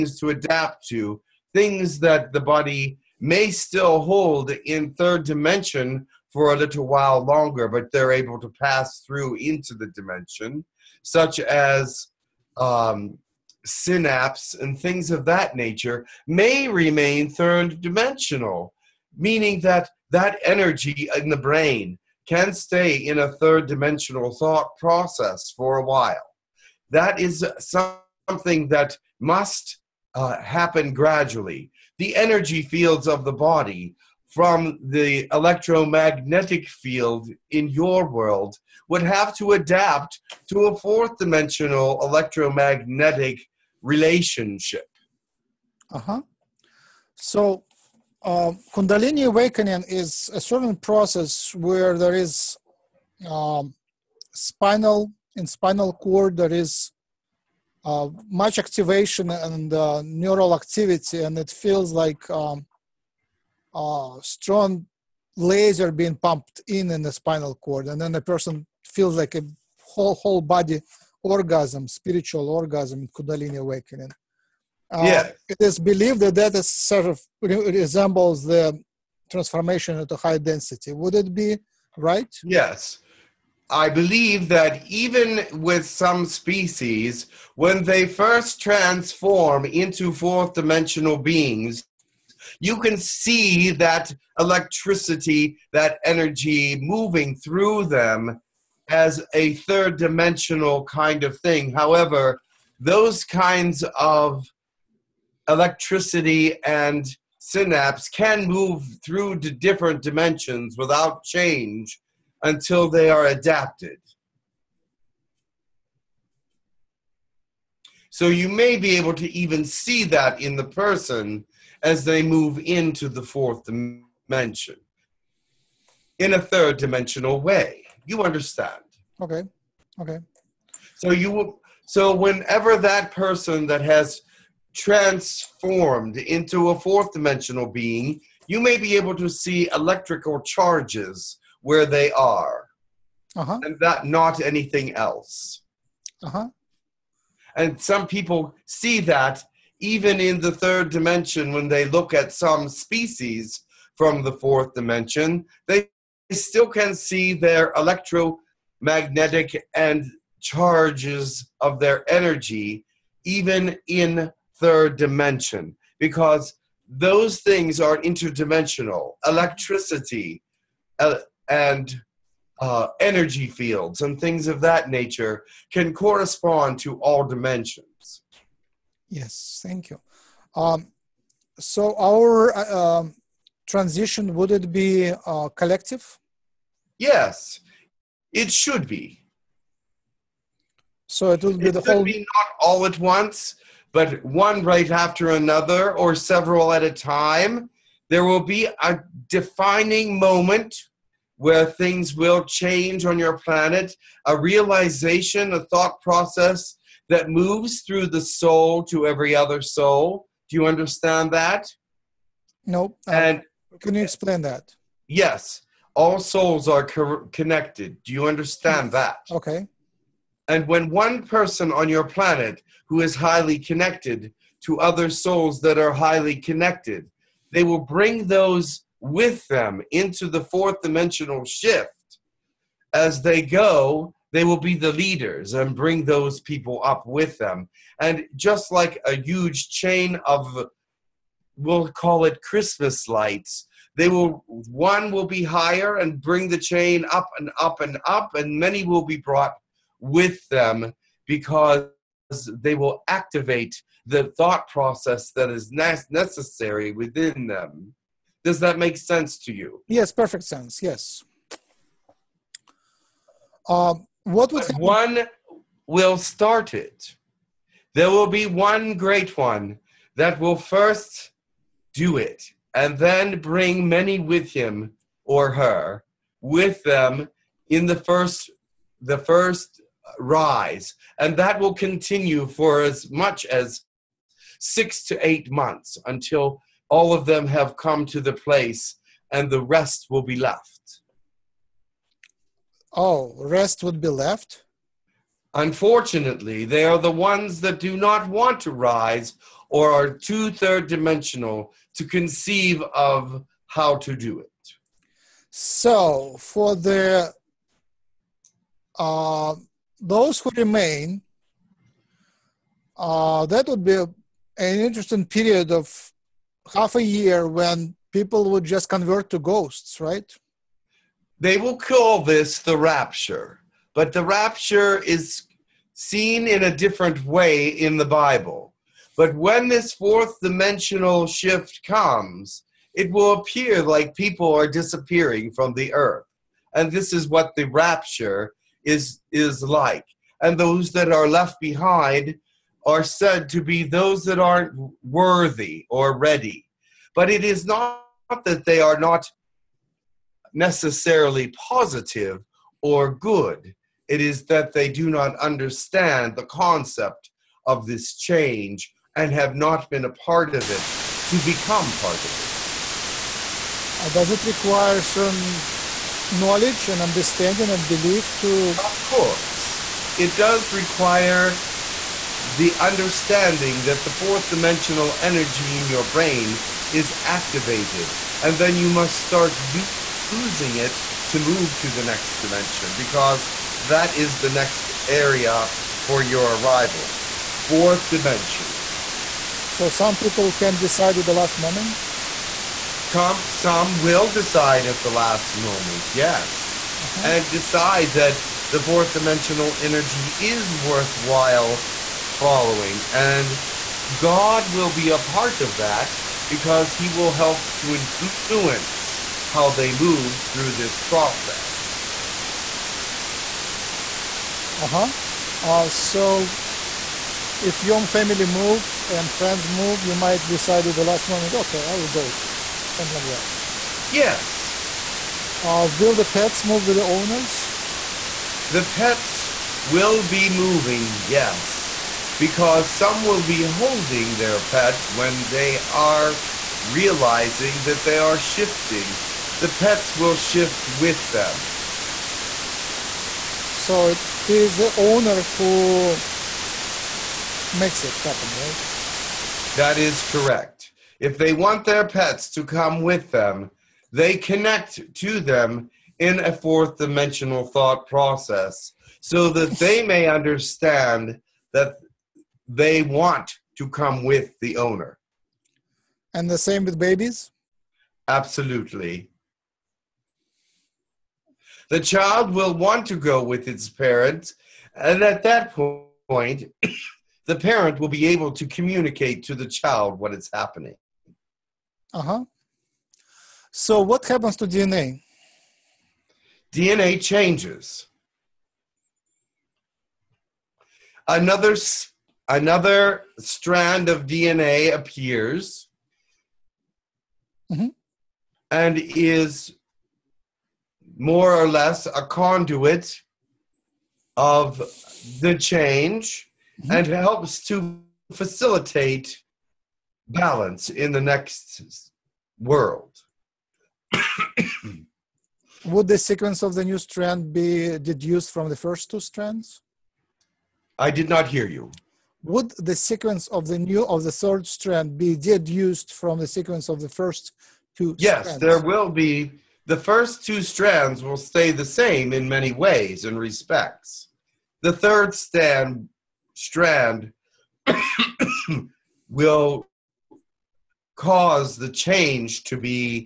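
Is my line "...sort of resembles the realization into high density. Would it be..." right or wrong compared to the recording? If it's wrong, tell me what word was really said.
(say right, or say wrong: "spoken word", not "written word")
wrong: "transformation", not "realization".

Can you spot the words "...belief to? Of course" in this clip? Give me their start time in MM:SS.
06:07.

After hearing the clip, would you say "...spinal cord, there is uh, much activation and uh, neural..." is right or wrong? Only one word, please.
right.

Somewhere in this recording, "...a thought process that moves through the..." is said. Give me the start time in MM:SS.
03:25.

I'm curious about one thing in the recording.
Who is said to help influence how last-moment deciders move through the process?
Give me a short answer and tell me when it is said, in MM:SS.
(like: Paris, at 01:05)
God, at 06:44.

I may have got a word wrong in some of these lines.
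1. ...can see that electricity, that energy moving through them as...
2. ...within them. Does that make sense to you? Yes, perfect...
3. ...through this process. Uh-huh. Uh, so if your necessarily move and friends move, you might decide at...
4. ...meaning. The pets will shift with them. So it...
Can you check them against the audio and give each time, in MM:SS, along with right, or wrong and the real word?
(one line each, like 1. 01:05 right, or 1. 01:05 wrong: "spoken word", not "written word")
1. 01:32 right
2. 04:16 right
3. 06:50 wrong: "family", not "necessarily"
4. 07:18 wrong: "shifting", not "meaning".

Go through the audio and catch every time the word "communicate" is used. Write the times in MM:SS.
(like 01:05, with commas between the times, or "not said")
07:58.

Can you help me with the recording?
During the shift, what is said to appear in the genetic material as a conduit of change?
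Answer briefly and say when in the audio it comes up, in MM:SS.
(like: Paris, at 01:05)
another strand of DNA, at 08:11.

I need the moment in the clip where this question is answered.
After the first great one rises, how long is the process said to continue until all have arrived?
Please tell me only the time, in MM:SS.
04:44.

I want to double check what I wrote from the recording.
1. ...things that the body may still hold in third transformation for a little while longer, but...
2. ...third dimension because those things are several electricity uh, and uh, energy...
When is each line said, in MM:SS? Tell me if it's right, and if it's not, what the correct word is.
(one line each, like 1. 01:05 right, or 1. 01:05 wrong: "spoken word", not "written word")
1. 00:01 wrong: "dimension", not "transformation"
2. 02:44 wrong: "interdimensional", not "several".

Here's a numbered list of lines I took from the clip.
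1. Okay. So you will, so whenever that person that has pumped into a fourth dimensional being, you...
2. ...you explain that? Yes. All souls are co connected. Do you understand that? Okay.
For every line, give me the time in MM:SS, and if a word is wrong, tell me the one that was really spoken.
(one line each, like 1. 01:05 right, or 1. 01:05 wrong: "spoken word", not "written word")
1. 02:10 wrong: "transformed", not "pumped"
2. 03:33 right.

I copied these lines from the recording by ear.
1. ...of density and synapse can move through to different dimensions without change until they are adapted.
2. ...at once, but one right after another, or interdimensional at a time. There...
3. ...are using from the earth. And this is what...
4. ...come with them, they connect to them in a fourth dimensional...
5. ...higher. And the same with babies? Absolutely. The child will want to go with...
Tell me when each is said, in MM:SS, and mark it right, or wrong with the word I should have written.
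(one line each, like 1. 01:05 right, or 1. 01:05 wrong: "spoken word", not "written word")
1. 01:43 wrong: "electricity", not "density"
2. 03:12 wrong: "several", not "interdimensional"
3. 05:34 wrong: "disappearing", not "using"
4. 07:32 right
5. 07:44 wrong: "owner", not "higher".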